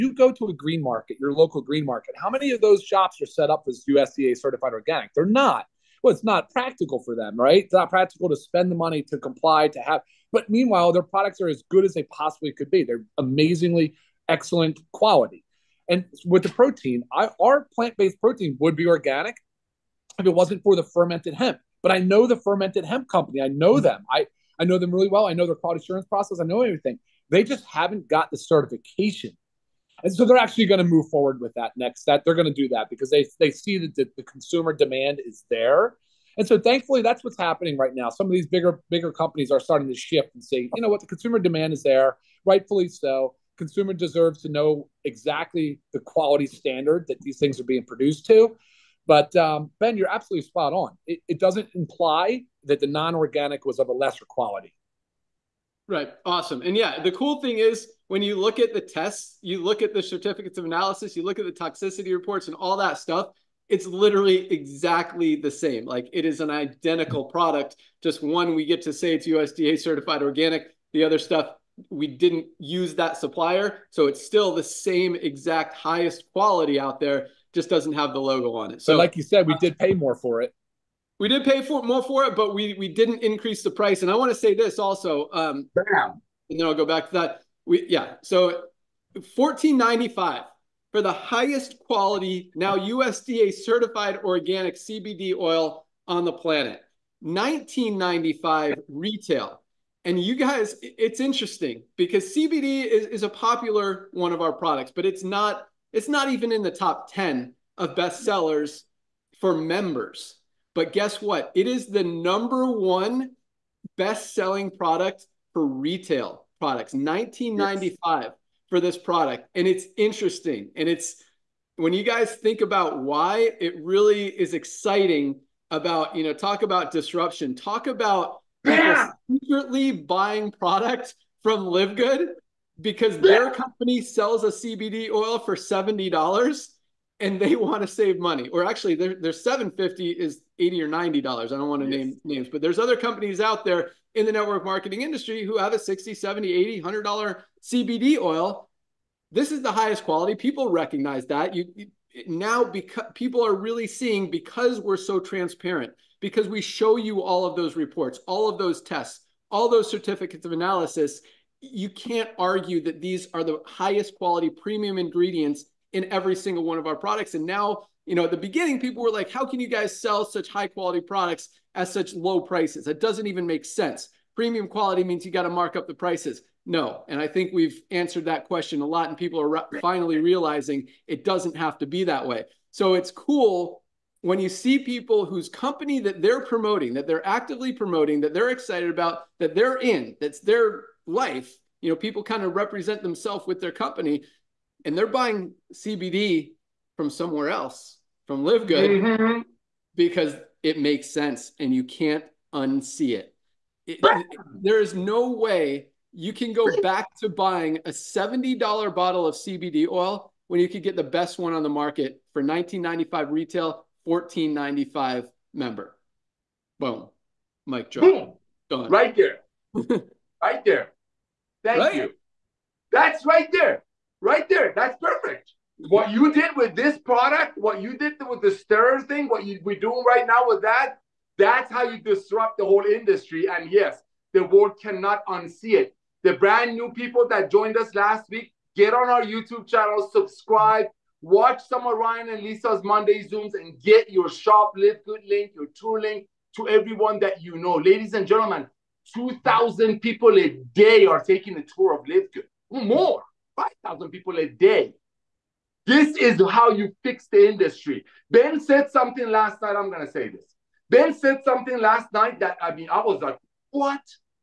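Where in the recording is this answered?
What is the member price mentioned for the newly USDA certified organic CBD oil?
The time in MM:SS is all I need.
01:29.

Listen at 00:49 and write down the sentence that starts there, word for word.
But um, Ben, you're absolutely spot on.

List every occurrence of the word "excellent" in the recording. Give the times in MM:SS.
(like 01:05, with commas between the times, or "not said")
00:14.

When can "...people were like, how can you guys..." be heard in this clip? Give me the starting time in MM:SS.
02:48.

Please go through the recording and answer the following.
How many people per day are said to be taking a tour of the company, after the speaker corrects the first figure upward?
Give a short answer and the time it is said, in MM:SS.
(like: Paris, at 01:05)
5,000, at 04:13.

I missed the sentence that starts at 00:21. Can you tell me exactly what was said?
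But I know the fermented hemp company.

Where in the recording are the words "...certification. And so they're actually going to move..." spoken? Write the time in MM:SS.
00:28.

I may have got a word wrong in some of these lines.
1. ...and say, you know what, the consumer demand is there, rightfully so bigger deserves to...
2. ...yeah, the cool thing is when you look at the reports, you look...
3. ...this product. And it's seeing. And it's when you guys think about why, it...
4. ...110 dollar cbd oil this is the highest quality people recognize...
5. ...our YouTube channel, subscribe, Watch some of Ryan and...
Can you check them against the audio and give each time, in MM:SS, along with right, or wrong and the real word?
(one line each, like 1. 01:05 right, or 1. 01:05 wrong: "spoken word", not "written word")
1. 00:40 wrong: "consumer", not "bigger"
2. 00:56 wrong: "tests", not "reports"
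3. 01:58 wrong: "interesting", not "seeing"
4. 02:26 wrong: "100", not "110"
5. 03:59 right.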